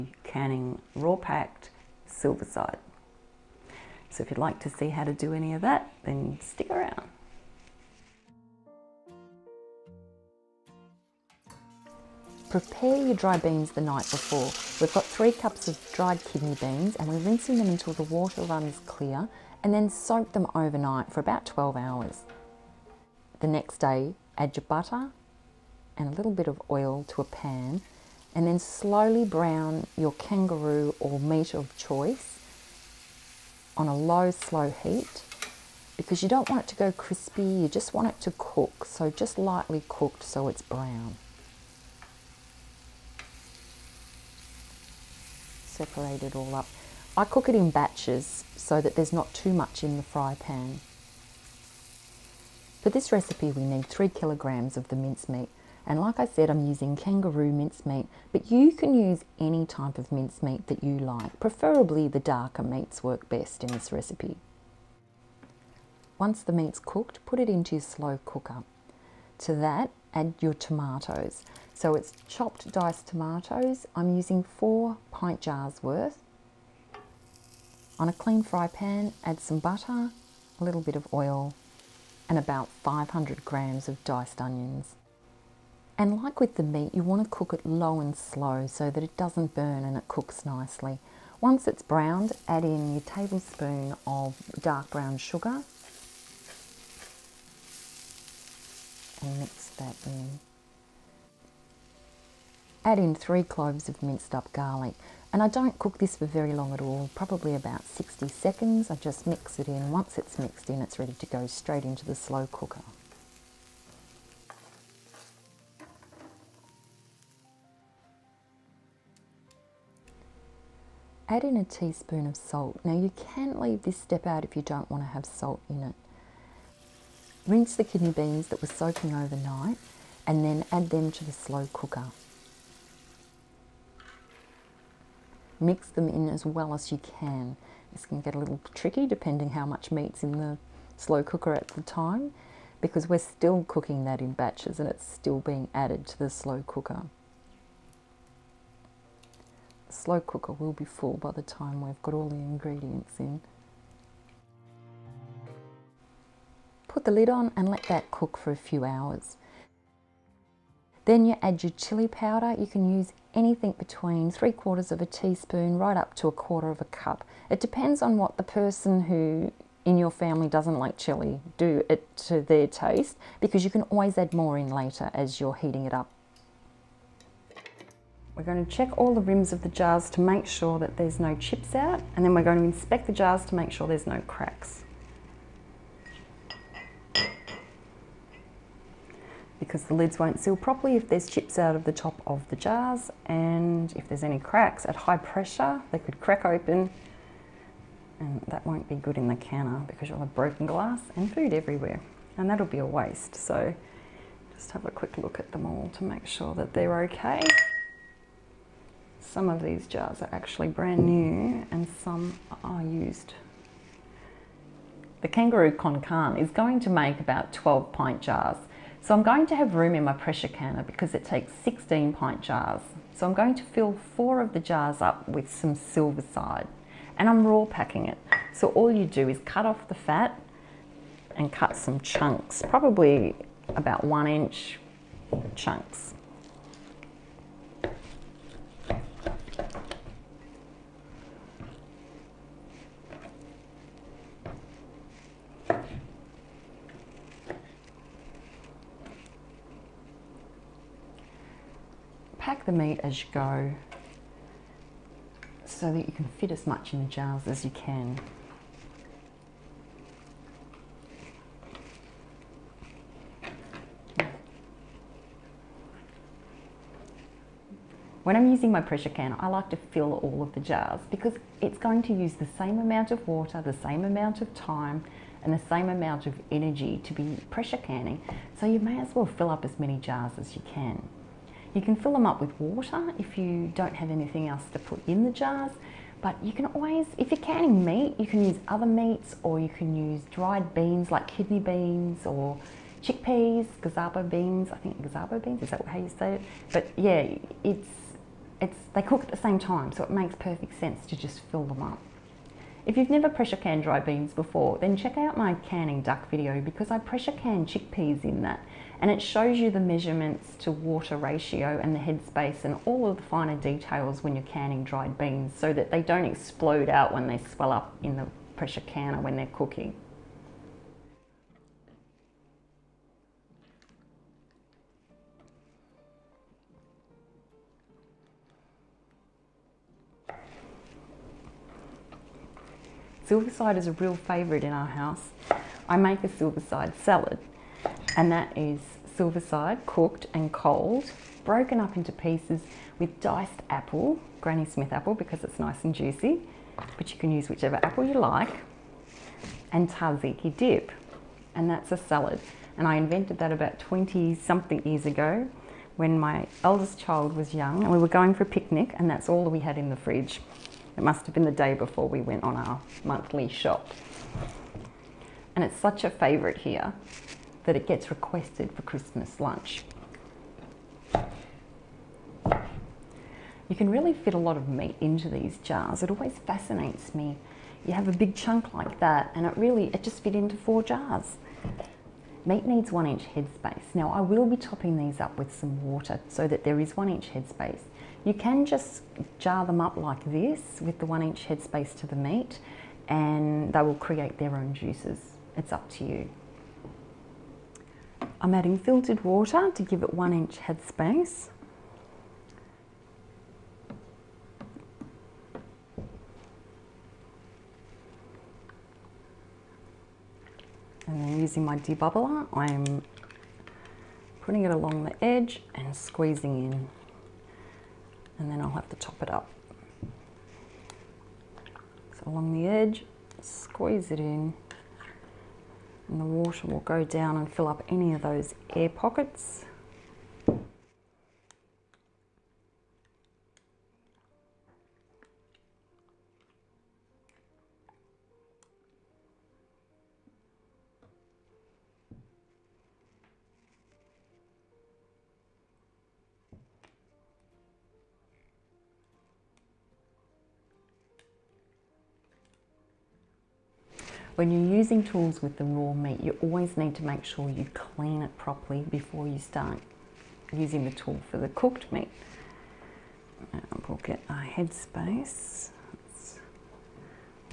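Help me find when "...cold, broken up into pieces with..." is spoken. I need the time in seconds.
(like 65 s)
340 s.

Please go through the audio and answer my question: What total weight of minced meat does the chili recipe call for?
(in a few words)
3 kilograms.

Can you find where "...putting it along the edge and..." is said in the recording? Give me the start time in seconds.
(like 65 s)
414 s.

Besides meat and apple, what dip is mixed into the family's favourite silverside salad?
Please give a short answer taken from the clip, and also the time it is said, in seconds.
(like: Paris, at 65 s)
tzatziki, at 349 s.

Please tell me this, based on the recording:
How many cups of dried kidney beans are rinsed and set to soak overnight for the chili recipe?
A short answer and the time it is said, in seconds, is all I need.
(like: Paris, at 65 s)
3, at 15 s.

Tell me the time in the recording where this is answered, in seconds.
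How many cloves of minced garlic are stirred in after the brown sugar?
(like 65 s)
103 s.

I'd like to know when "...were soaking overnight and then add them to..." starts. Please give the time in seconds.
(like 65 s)
128 s.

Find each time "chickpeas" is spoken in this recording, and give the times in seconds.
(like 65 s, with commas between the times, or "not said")
293 s, 307 s.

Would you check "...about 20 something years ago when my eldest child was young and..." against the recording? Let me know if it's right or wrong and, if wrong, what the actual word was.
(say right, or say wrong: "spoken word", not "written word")
right.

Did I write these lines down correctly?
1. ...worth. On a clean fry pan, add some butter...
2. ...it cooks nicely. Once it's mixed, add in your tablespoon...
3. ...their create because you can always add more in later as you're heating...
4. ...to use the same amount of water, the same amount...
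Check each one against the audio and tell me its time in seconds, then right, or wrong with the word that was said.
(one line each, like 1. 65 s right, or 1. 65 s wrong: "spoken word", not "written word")
1. 75 s right
2. 89 s wrong: "browned", not "mixed"
3. 172 s wrong: "taste", not "create"
4. 272 s right.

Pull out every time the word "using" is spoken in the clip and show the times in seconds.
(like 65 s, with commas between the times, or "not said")
56 s, 74 s, 268 s, 411 s, 454 s, 460 s.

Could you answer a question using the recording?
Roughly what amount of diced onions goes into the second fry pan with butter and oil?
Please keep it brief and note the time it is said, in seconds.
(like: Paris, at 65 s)
500 grams, at 82 s.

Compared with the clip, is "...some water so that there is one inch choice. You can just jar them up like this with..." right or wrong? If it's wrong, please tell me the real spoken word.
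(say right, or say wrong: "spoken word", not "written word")
wrong: "headspace", not "choice".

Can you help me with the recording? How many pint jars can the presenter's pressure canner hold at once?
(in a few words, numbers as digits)
16.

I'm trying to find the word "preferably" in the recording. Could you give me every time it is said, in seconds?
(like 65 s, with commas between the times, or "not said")
61 s.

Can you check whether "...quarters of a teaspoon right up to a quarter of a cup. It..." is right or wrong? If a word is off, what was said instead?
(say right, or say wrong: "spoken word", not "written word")
right.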